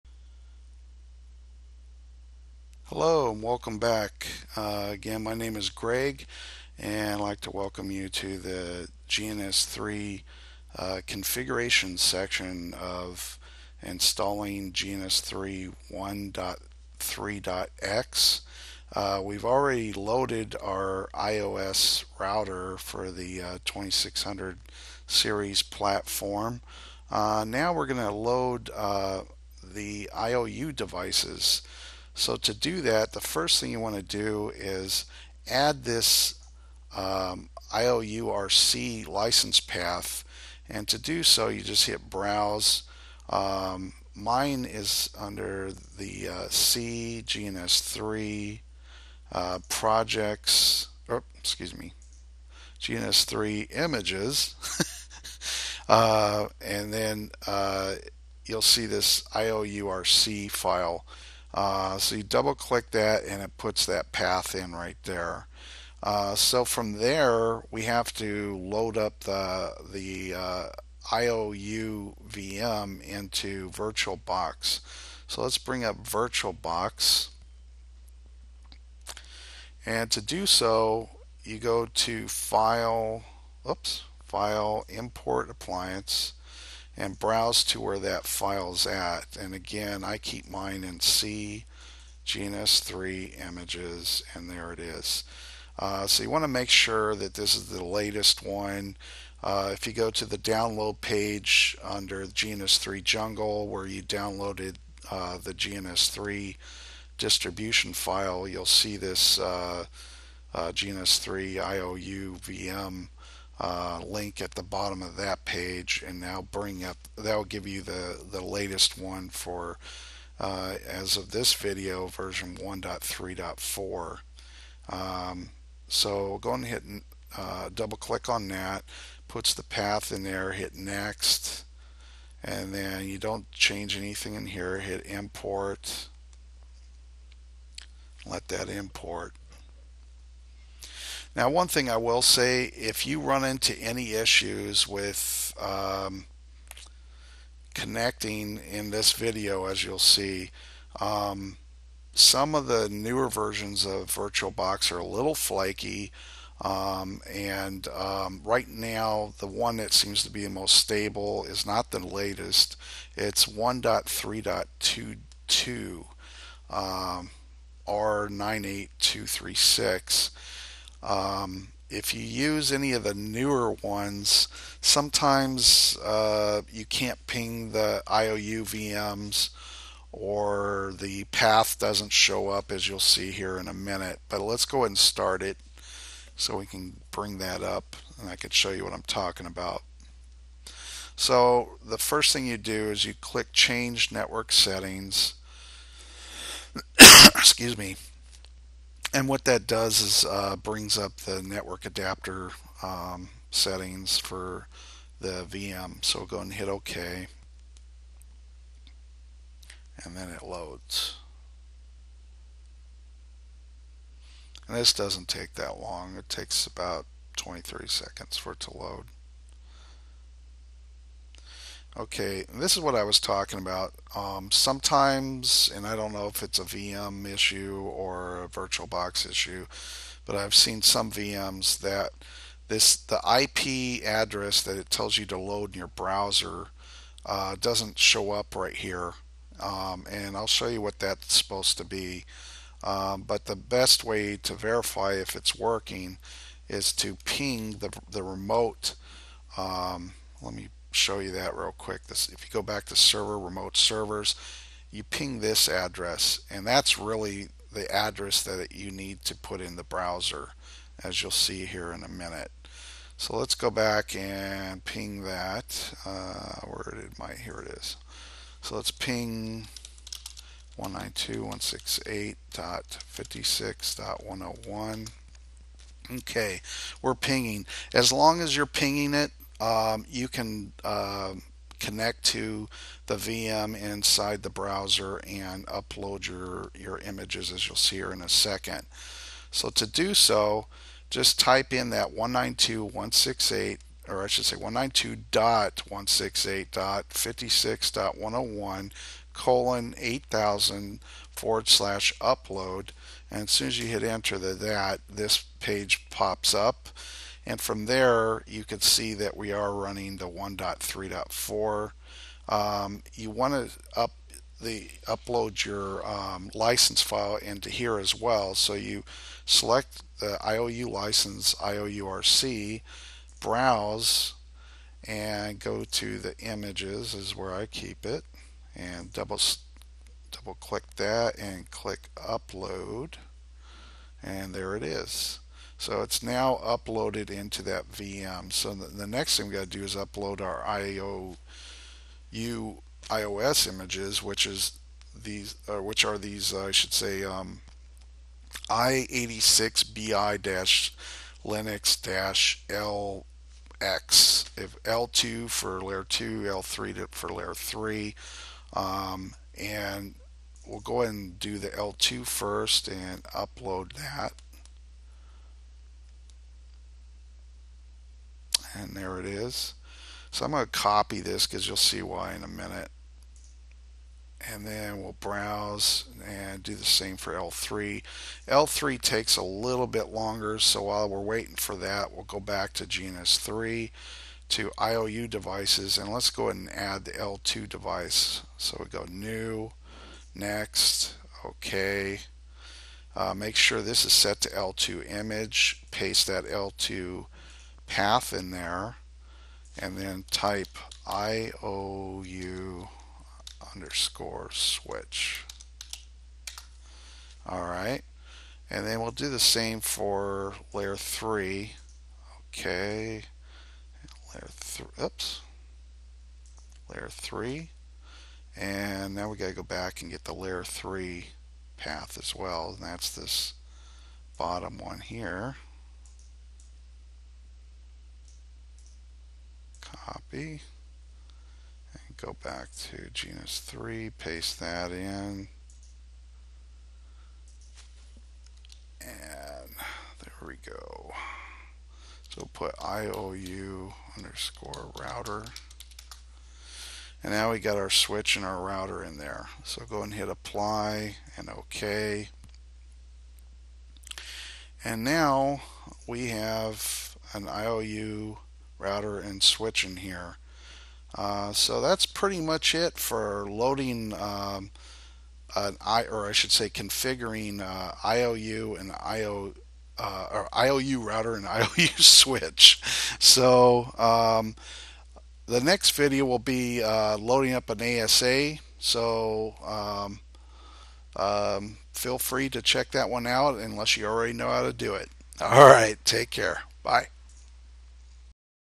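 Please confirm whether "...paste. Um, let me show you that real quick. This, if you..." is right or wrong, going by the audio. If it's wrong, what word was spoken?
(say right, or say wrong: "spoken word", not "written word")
wrong: "remote", not "paste".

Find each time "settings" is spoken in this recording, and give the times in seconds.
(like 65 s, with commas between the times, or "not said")
194 s, 203 s.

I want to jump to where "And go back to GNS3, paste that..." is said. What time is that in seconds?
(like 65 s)
431 s.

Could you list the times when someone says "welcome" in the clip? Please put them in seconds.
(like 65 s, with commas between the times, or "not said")
3 s, 7 s.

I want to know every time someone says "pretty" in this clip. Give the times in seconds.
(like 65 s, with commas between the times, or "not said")
462 s.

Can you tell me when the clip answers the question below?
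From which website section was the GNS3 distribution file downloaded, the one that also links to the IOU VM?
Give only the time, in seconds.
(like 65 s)
102 s.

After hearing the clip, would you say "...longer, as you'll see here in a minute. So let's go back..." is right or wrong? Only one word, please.
wrong.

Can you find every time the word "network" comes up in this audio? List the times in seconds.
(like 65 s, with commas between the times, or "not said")
194 s, 201 s.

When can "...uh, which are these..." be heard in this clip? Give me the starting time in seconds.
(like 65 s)
345 s.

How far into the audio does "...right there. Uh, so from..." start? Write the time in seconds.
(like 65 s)
64 s.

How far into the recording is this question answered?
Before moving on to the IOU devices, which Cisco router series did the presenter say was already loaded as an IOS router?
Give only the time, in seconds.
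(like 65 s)
23 s.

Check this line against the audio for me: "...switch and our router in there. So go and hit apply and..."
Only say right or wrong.
right.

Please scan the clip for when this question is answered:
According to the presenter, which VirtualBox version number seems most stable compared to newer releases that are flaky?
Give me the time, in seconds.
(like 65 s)
163 s.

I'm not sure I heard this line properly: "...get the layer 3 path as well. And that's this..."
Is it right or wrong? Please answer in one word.
right.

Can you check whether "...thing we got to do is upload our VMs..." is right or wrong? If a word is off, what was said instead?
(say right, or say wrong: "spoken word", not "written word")
wrong: "IOU", not "VMs".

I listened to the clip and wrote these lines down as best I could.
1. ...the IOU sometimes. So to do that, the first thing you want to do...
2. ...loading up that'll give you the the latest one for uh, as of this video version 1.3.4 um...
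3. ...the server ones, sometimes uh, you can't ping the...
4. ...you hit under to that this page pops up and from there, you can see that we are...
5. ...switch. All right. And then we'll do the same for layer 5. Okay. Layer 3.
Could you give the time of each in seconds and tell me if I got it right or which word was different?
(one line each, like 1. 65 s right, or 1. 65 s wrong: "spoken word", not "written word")
1. 29 s wrong: "devices", not "sometimes"
2. 116 s wrong: "bring", not "loading"
3. 173 s wrong: "newer", not "server"
4. 303 s wrong: "enter", not "under"
5. 404 s wrong: "3", not "5".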